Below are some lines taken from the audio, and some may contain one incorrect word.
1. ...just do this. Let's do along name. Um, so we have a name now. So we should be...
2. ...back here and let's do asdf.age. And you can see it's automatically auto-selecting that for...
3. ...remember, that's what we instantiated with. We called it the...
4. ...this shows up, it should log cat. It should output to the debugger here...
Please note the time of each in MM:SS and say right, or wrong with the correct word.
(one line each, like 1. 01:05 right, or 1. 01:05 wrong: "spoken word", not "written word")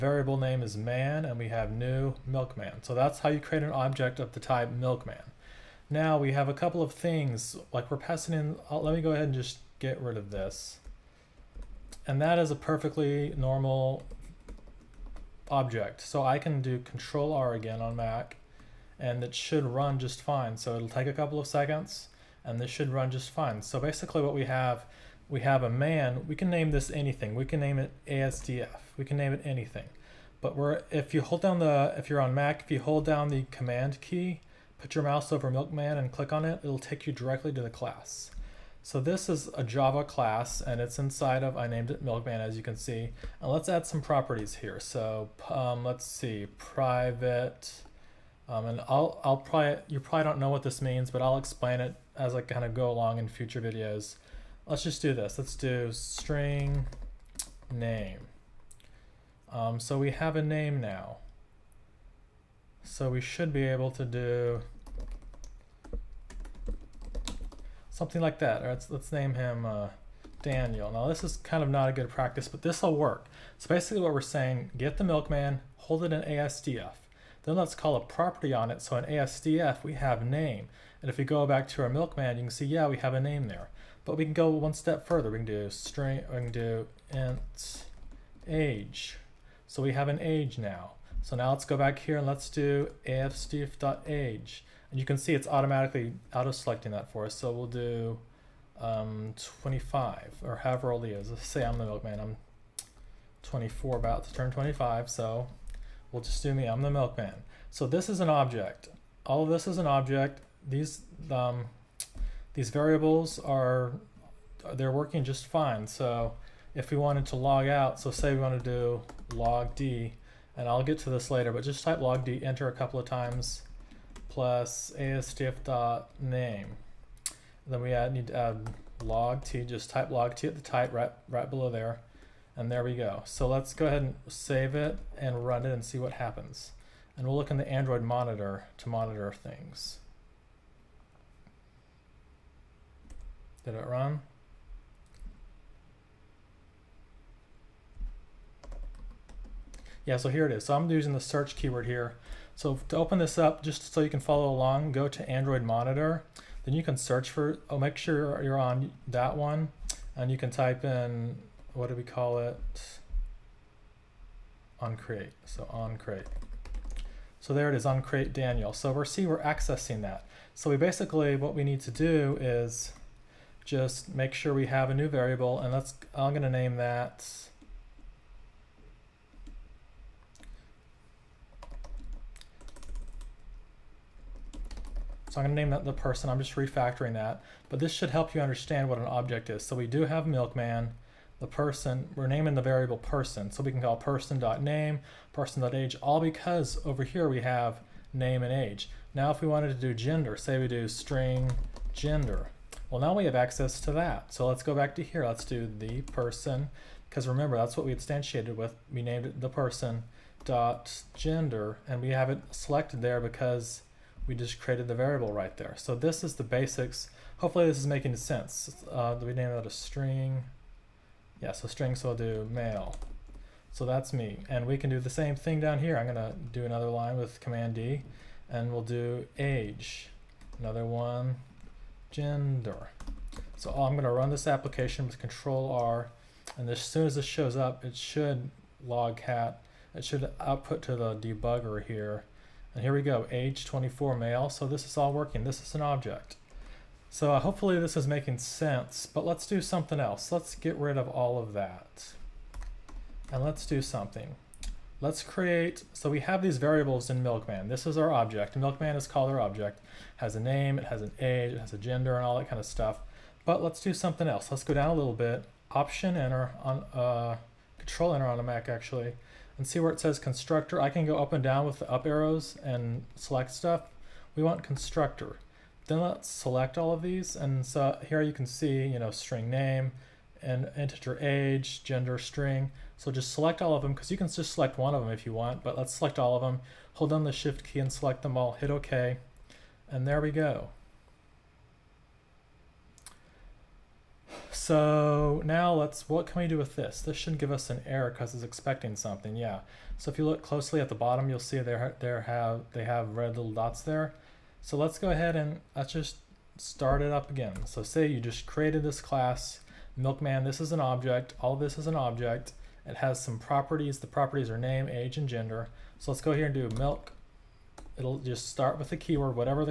1. 00:54 wrong: "string", not "along"
2. 01:31 right
3. 03:27 wrong: "named", not "called"
4. 03:57 right.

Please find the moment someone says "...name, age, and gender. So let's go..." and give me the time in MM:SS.
05:14.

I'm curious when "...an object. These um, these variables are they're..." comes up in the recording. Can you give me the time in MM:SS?
01:49.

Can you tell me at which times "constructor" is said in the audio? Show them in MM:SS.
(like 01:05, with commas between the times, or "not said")
04:30, 04:34.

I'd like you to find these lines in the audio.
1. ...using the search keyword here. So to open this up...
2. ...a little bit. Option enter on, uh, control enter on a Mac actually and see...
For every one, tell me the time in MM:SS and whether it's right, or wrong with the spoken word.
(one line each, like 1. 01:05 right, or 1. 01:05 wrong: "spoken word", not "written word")
1. 02:30 right
2. 04:24 right.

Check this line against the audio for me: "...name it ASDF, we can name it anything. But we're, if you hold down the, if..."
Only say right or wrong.
right.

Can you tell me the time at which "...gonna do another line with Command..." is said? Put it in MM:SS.
03:46.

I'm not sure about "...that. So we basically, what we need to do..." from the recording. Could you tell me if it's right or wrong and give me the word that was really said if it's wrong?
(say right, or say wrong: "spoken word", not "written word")
right.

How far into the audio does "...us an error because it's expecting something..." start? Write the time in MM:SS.
04:57.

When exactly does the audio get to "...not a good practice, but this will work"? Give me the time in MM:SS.
01:11.